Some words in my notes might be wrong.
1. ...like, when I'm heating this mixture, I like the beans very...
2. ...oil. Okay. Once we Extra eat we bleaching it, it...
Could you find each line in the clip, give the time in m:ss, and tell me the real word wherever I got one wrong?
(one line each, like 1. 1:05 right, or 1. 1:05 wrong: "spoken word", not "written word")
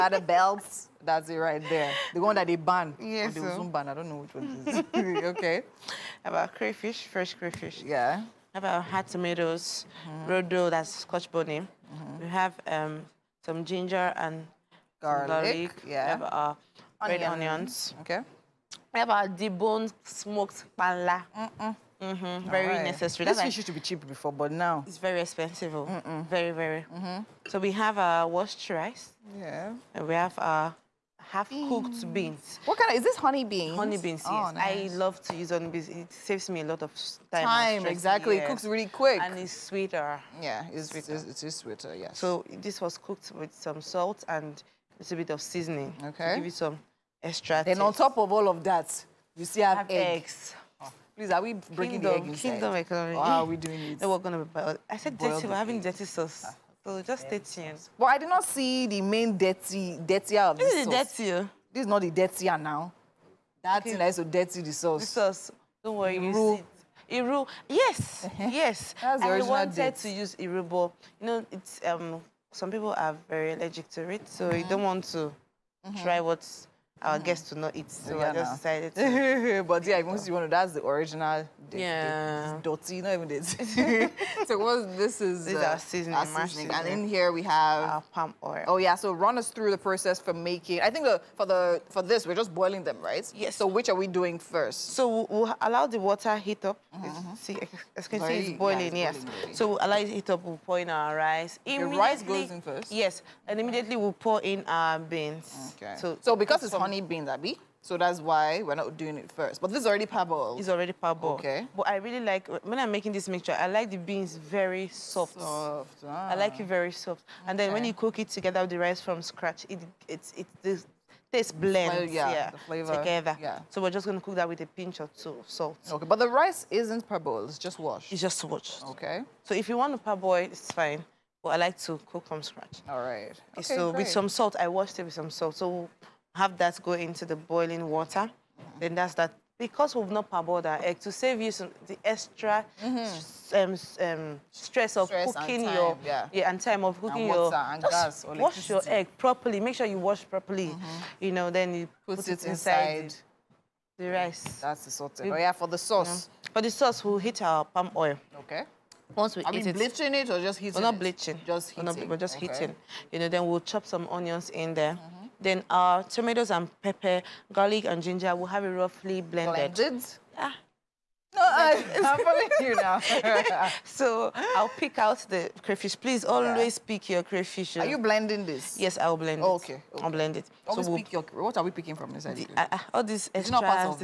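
1. 1:52 wrong: "making", not "heating"
2. 2:37 wrong: "Are", not "Extra".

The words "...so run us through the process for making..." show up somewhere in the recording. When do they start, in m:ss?
1:28.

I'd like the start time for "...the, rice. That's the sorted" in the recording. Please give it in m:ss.
2:33.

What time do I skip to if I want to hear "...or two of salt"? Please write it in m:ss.
2:05.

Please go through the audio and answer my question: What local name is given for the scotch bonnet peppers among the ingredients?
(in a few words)
rodo.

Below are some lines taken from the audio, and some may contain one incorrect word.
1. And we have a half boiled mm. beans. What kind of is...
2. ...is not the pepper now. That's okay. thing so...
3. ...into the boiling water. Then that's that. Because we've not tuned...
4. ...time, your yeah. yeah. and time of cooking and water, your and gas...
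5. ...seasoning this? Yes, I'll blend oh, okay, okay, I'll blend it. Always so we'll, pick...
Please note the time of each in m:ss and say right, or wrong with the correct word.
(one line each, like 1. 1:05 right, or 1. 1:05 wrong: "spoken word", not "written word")
1. 0:29 wrong: "cooked", not "boiled"
2. 1:01 wrong: "dirtier", not "pepper"
3. 2:16 wrong: "parboiled", not "tuned"
4. 2:25 right
5. 2:58 wrong: "blending", not "seasoning".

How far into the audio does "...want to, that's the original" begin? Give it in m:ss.
1:20.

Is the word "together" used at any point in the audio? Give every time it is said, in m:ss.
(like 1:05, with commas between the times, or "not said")
1:58, 2:02.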